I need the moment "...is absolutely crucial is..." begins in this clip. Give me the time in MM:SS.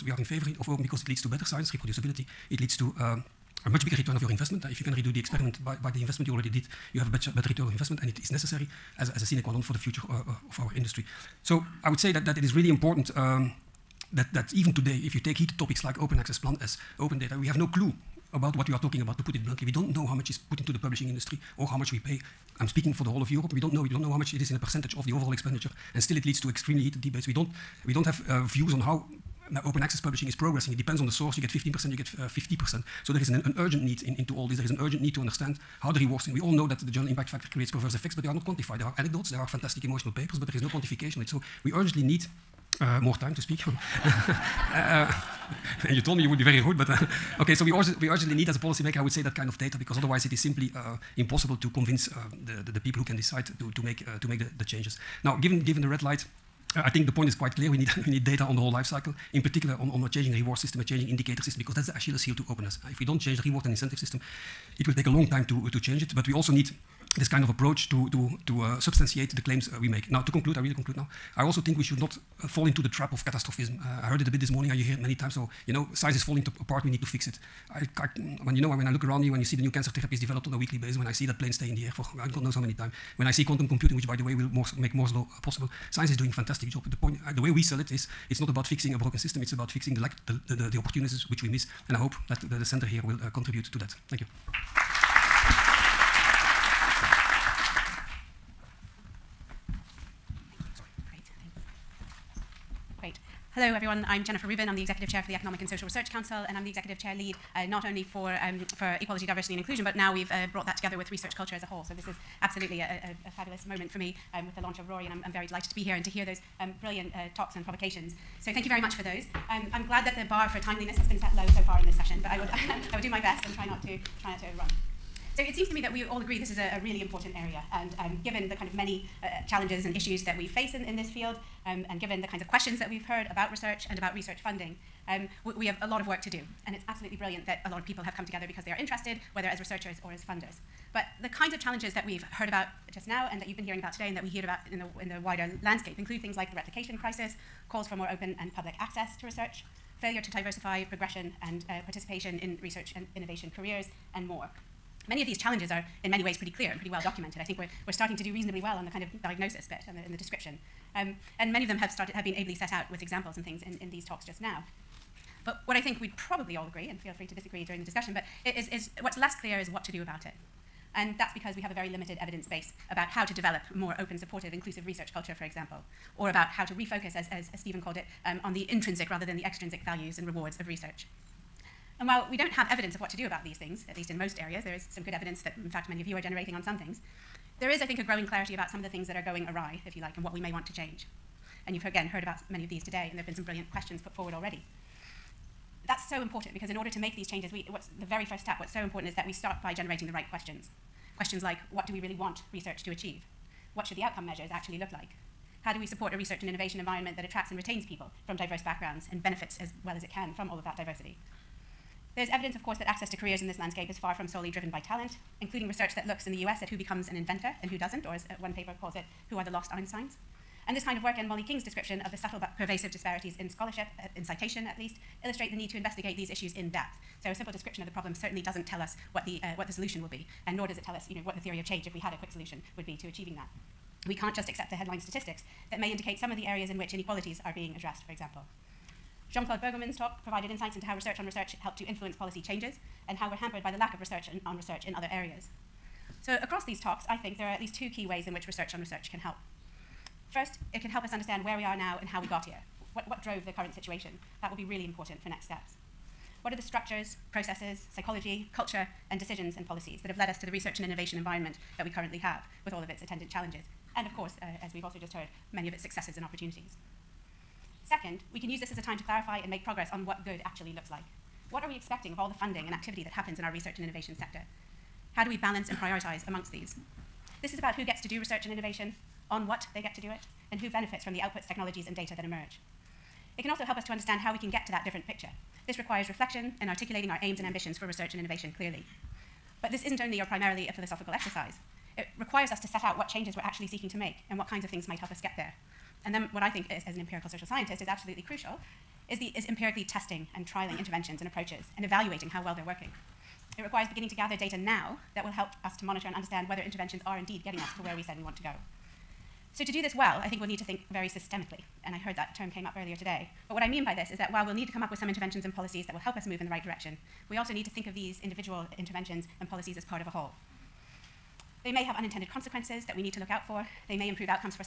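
04:57.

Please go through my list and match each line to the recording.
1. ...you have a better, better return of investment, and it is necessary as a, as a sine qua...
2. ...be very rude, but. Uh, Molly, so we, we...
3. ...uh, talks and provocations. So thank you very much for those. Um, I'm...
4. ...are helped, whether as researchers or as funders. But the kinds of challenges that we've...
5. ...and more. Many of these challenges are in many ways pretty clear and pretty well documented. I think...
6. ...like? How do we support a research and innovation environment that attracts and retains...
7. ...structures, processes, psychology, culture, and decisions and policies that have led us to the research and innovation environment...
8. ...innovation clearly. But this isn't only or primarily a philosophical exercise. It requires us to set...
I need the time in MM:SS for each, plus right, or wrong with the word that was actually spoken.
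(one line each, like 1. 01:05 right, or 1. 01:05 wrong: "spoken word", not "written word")
1. 00:06 right
2. 00:46 wrong: "Okay", not "Molly"
3. 01:57 right
4. 02:18 wrong: "interested", not "helped"
5. 02:34 right
6. 03:24 right
7. 04:16 right
8. 04:48 right.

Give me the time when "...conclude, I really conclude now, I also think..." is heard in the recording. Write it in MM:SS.
01:10.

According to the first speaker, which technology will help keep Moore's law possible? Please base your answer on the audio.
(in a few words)
quantum computing.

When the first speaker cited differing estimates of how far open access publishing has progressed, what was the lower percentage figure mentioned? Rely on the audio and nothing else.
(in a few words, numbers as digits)
15%.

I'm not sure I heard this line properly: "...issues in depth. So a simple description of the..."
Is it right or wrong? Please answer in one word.
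right.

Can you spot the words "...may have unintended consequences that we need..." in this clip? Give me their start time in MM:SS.
05:21.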